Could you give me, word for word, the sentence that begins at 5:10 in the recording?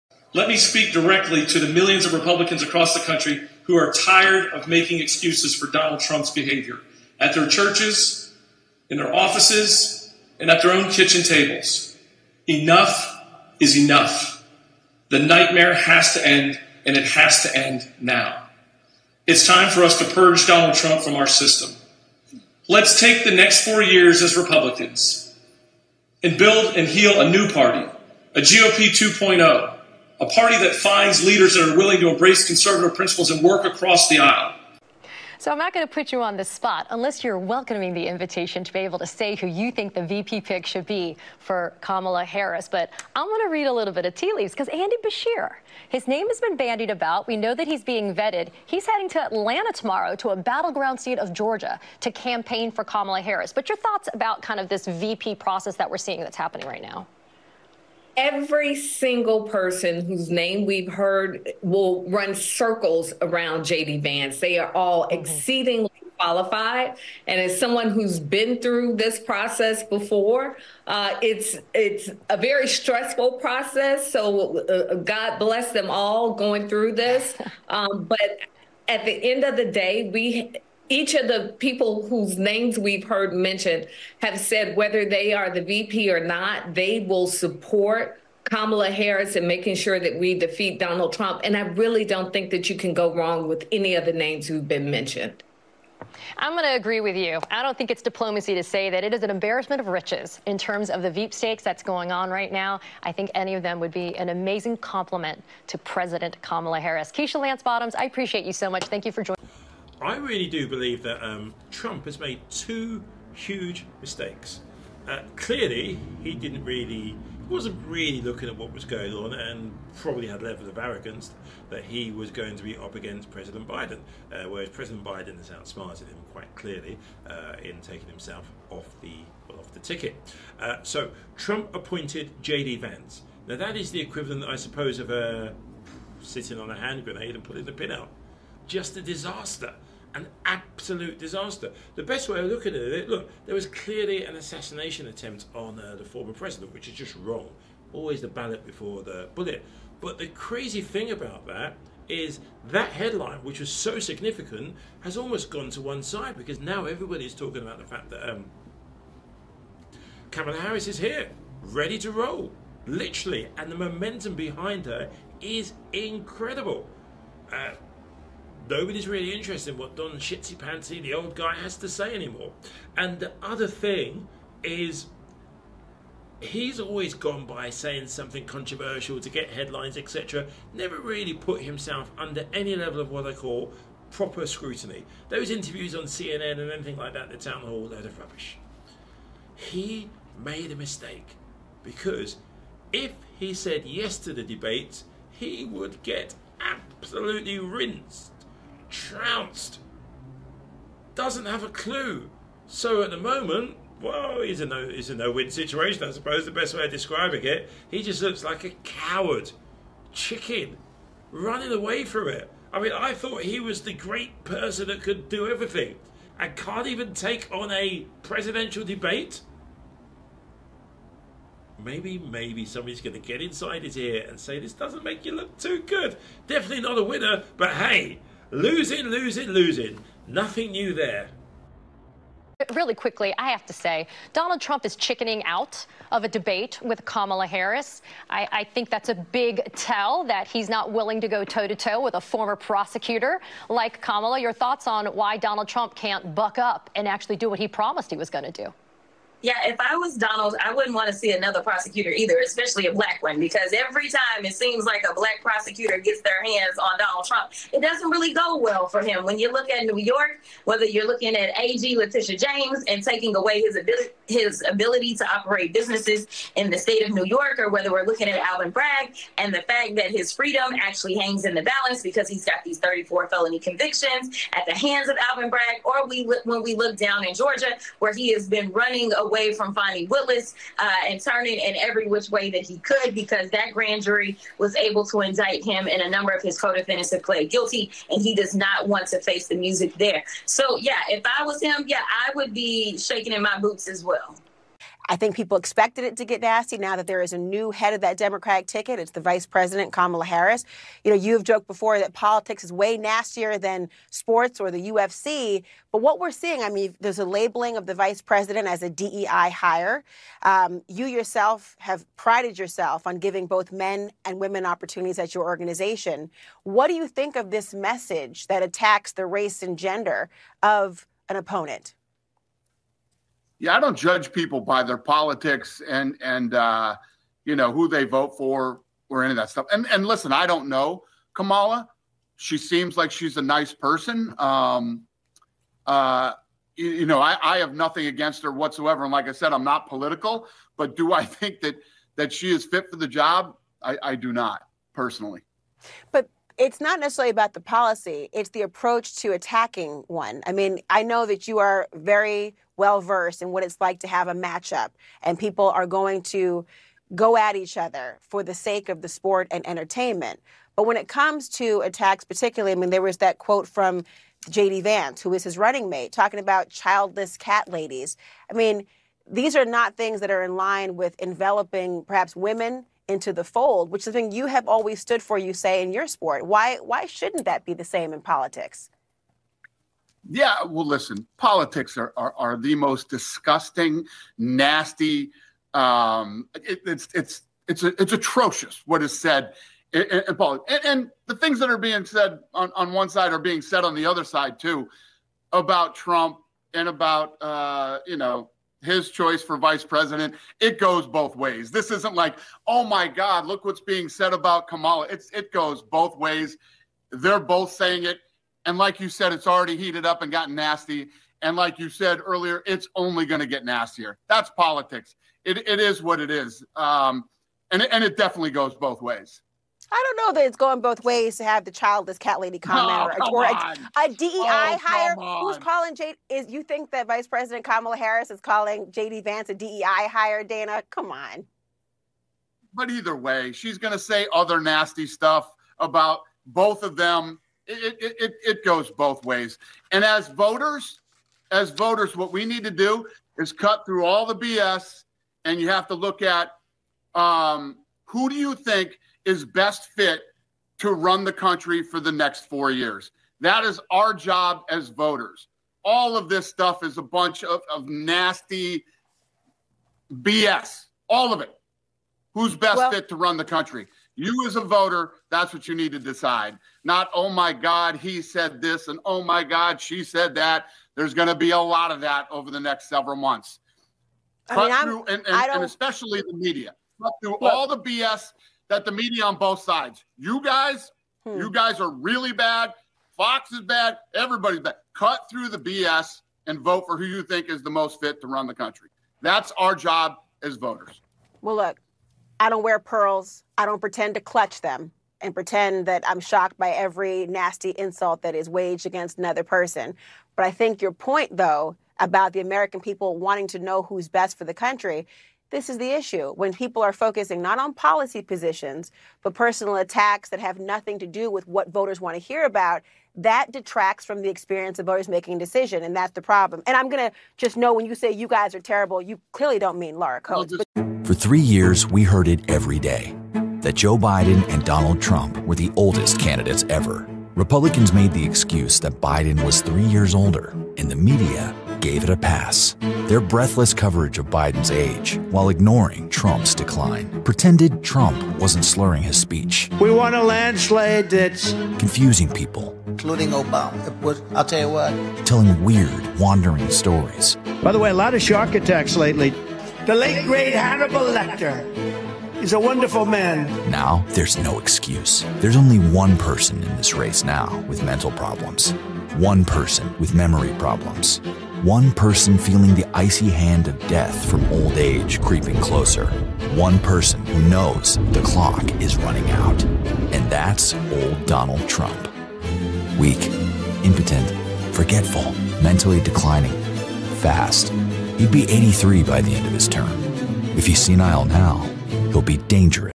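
Um, you yourself have prided yourself on giving both men and women opportunities at your organization.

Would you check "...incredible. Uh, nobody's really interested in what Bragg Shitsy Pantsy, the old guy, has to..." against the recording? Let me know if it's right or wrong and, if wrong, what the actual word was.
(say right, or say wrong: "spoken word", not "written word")
wrong: "Don", not "Bragg".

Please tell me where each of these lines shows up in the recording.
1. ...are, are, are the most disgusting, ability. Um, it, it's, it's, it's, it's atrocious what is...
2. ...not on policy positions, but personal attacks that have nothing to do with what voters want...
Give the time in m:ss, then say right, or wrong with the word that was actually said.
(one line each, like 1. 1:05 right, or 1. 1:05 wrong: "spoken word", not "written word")
1. 6:21 wrong: "nasty", not "ability"
2. 8:27 right.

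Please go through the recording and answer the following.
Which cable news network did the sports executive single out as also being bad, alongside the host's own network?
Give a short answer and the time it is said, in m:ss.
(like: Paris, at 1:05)
Fox, at 8:03.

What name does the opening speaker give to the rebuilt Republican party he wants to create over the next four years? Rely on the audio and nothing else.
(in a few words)
GOP 2.0.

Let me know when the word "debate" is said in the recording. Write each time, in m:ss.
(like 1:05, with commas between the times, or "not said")
3:14, 3:38, 3:56.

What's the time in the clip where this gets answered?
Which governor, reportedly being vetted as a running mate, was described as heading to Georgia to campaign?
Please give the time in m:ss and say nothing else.
0:44.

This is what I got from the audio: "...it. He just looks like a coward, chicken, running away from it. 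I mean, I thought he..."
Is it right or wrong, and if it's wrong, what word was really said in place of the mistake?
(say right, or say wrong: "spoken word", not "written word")
right.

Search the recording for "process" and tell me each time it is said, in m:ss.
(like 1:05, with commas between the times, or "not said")
0:55, 1:09, 1:13.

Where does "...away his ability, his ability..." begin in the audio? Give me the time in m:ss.
4:23.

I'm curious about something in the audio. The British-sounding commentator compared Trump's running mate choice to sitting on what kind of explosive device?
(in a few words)
hand grenade.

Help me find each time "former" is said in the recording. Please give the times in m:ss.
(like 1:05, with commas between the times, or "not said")
2:26, 4:02.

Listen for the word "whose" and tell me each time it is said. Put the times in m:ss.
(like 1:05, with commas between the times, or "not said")
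1:00, 1:22.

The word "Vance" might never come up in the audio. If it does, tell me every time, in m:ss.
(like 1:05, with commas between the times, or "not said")
1:04, 2:12, 6:04, 7:09.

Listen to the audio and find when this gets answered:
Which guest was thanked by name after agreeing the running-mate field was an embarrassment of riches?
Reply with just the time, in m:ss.
1:47.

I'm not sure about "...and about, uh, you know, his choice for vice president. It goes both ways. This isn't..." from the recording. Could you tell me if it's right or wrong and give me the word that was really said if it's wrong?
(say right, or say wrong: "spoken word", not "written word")
right.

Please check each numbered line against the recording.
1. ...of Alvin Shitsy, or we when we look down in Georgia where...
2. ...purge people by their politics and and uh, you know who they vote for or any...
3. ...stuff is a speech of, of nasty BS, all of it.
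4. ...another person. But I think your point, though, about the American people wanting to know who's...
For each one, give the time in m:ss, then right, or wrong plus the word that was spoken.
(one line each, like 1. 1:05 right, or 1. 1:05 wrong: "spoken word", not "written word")
1. 4:35 wrong: "Bragg", not "Shitsy"
2. 5:23 wrong: "judge", not "purge"
3. 7:36 wrong: "bunch", not "speech"
4. 8:19 right.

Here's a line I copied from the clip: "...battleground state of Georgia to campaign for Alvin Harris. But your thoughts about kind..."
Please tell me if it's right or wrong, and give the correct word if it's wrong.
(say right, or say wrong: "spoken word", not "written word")
wrong: "Kamala", not "Alvin".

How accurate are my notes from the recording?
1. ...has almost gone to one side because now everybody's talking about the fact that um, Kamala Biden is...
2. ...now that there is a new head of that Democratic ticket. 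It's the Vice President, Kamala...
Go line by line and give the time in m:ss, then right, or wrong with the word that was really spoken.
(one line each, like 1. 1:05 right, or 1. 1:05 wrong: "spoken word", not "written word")
1. 2:35 wrong: "Harris", not "Biden"
2. 4:56 right.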